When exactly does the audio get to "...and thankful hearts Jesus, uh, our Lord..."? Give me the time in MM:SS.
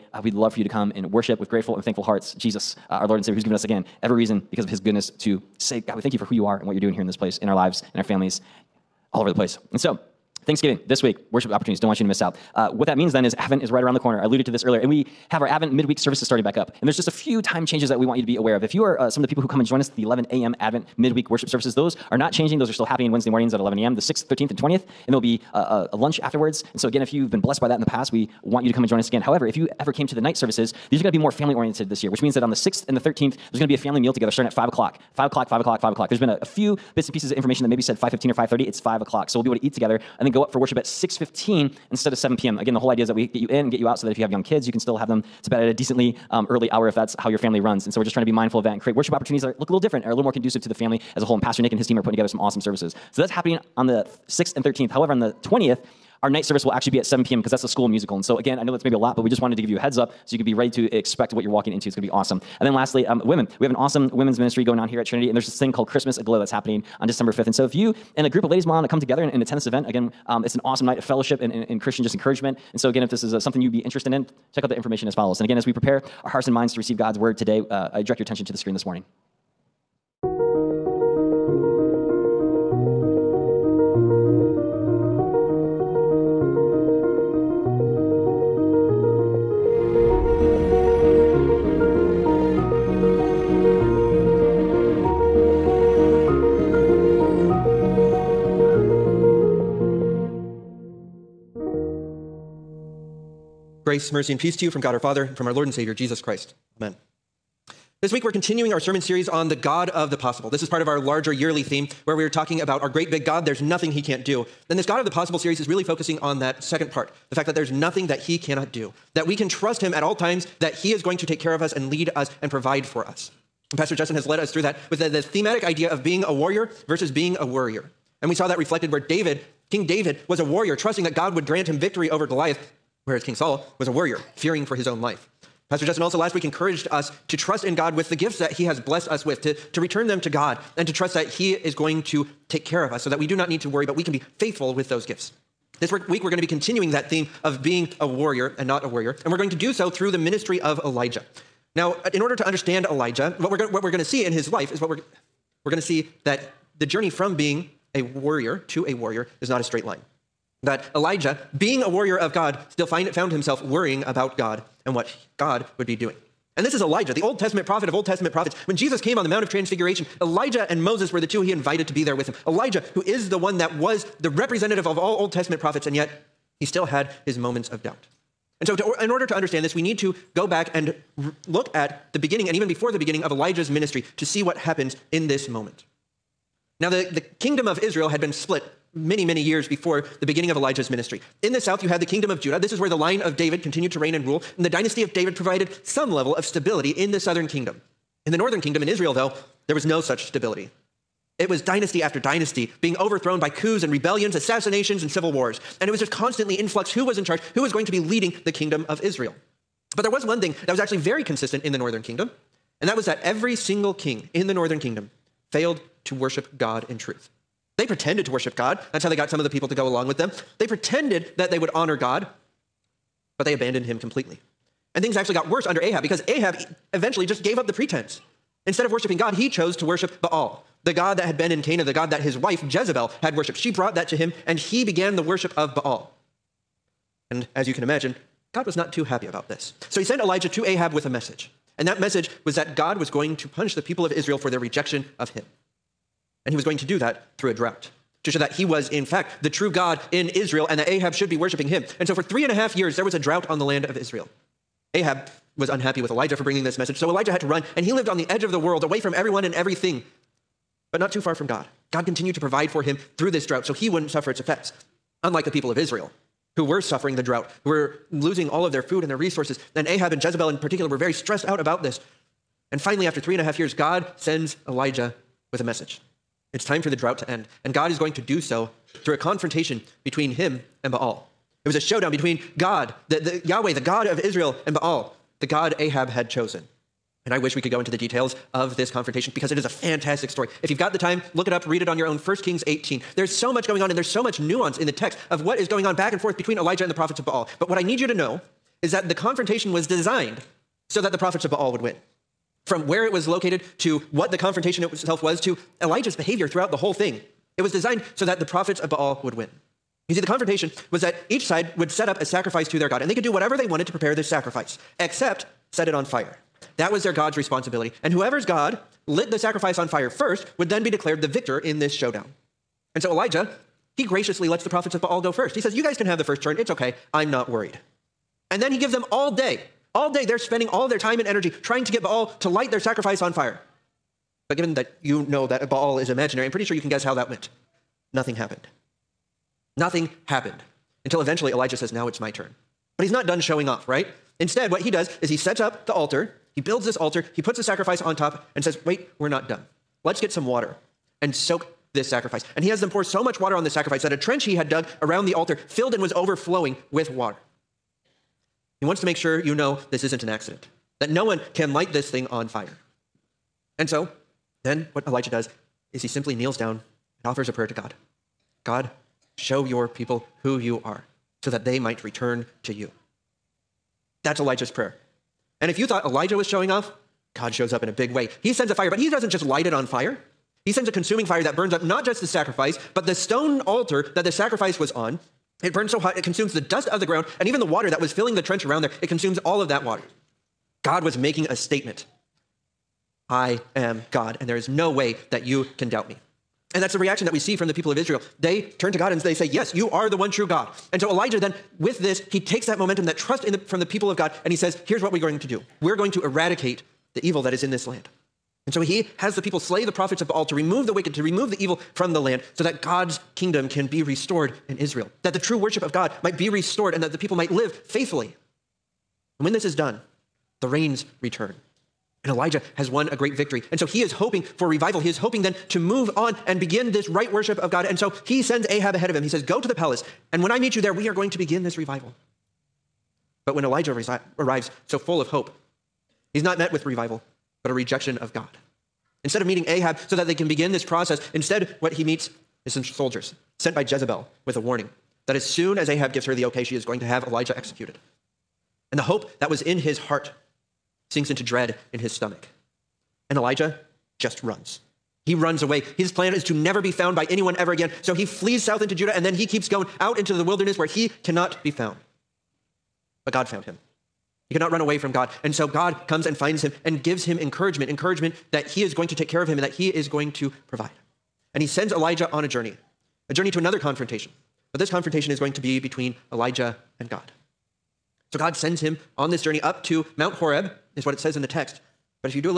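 00:01.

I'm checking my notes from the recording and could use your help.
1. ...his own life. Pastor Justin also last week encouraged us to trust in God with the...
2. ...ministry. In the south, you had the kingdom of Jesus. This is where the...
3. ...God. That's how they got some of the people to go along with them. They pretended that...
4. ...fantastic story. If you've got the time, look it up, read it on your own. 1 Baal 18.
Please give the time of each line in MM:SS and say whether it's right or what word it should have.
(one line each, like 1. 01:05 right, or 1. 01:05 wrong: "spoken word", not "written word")
1. 02:14 right
2. 03:10 wrong: "Judah", not "Jesus"
3. 03:38 right
4. 04:49 wrong: "Kings", not "Baal".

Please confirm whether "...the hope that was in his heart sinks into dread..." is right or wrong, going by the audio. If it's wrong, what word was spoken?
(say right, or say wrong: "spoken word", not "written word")
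right.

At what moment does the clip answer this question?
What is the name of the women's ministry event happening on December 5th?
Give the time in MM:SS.
01:05.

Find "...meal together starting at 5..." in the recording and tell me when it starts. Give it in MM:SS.
00:33.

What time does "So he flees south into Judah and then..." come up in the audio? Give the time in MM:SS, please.
07:38.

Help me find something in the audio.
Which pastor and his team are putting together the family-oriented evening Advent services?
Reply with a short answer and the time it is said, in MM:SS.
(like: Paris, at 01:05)
Pastor Nick, at 00:51.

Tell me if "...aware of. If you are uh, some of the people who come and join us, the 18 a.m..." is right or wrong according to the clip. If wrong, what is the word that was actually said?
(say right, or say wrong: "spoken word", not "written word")
wrong: "11", not "18".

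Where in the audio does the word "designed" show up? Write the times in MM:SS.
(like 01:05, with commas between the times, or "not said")
04:59, 05:07.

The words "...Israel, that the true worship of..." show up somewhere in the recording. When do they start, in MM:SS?
06:54.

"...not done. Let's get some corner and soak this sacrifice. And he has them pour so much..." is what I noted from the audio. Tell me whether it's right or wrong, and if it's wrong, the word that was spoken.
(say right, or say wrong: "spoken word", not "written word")
wrong: "water", not "corner".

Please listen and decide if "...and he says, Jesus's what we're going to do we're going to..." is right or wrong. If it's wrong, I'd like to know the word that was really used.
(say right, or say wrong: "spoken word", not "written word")
wrong: "Here", not "Jesus".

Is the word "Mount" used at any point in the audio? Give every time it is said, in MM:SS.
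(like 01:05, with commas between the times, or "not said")
02:49, 08:00.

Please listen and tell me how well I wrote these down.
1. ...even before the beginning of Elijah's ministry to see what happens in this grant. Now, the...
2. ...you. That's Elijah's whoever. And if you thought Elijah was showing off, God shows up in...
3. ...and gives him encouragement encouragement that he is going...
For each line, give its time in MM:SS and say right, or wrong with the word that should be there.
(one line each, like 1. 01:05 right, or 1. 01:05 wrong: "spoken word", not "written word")
1. 03:02 wrong: "moment", not "grant"
2. 06:12 wrong: "prayer", not "whoever"
3. 07:46 right.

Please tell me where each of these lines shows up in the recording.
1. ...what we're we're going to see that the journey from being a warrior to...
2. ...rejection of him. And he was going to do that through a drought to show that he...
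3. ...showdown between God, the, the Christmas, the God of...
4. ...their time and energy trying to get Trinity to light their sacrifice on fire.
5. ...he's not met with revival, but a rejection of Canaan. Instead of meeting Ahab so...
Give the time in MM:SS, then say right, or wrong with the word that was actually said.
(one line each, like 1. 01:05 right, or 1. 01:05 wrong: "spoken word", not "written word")
1. 02:34 right
2. 04:04 right
3. 04:41 wrong: "Yahweh", not "Christmas"
4. 05:30 wrong: "Baal", not "Trinity"
5. 07:16 wrong: "God", not "Canaan".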